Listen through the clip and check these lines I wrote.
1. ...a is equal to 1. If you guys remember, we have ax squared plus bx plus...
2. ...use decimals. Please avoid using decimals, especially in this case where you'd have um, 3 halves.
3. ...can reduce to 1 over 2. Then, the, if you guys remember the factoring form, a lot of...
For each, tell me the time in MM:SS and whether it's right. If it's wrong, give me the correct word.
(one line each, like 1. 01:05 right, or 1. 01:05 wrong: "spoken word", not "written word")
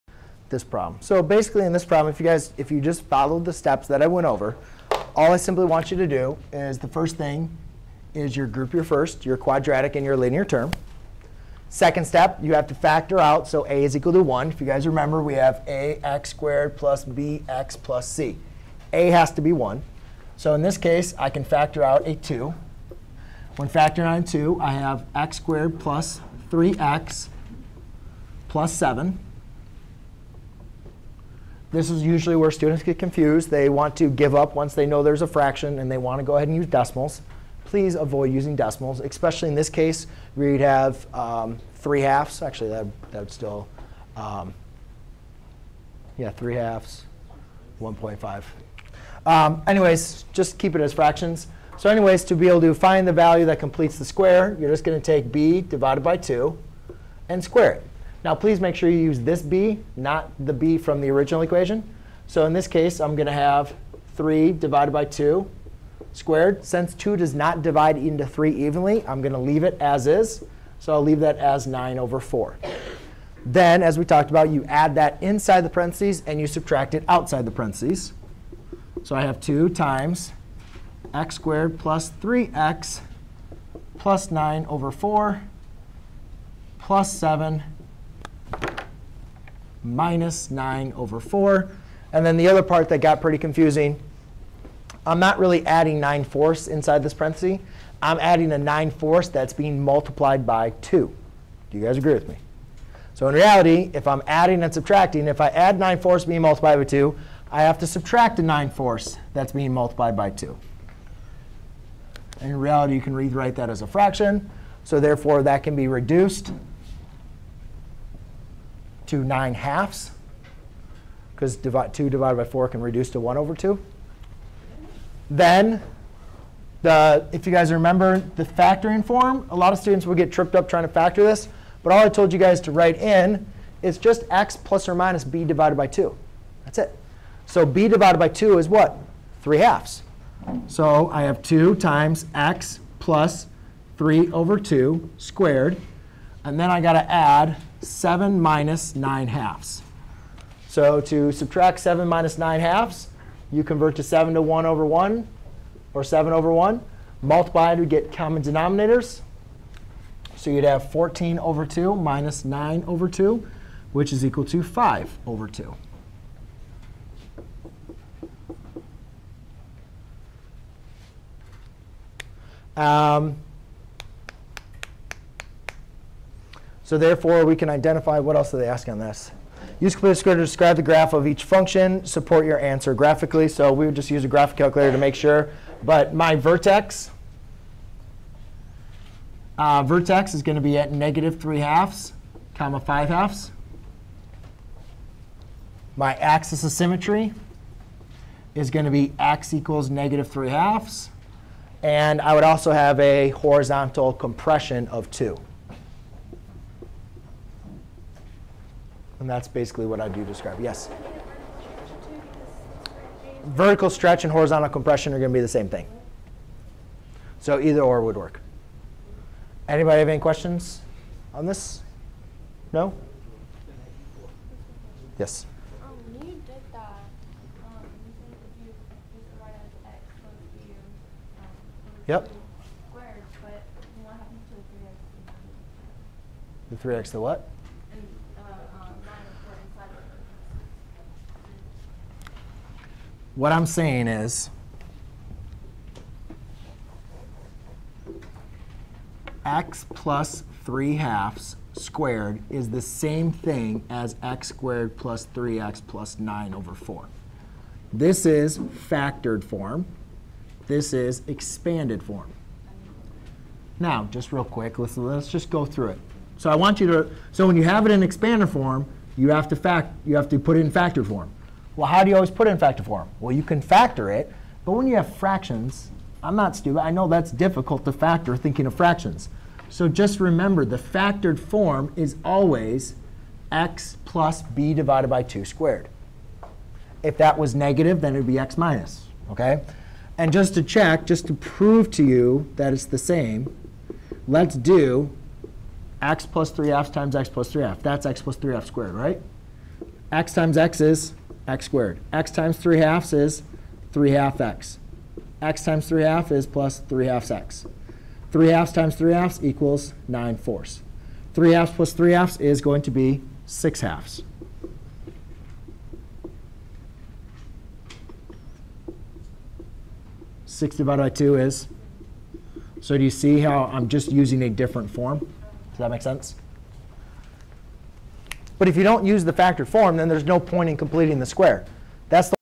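1. 00:13 right
2. 00:36 right
3. 02:02 right.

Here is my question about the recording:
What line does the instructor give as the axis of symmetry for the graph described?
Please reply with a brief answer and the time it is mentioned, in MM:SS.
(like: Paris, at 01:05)
x = -3/2, at 03:19.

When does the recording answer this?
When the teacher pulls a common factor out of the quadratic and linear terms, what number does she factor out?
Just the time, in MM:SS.
00:21.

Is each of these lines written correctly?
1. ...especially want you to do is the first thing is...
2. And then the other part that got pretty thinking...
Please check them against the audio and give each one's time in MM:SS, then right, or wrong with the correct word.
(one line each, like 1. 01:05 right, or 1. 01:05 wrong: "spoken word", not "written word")
1. 00:05 wrong: "simply", not "especially"
2. 01:32 wrong: "confusing", not "thinking".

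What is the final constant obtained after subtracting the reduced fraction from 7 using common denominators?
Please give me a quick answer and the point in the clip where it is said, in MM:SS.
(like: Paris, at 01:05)
5/2, at 02:43.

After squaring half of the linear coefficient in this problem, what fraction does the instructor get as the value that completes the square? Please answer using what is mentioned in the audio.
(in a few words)
9/4.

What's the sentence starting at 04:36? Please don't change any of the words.
I know that's difficult to factor thinking of fractions.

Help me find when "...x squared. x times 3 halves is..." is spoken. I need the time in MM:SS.
05:01.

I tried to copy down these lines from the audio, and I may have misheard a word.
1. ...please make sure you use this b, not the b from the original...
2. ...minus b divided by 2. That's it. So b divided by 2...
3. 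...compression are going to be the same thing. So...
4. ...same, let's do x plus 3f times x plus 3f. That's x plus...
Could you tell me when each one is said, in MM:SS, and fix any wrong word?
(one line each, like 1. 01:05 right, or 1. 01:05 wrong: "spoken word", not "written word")
1. 00:58 right
2. 02:14 right
3. 03:34 right
4. 04:52 right.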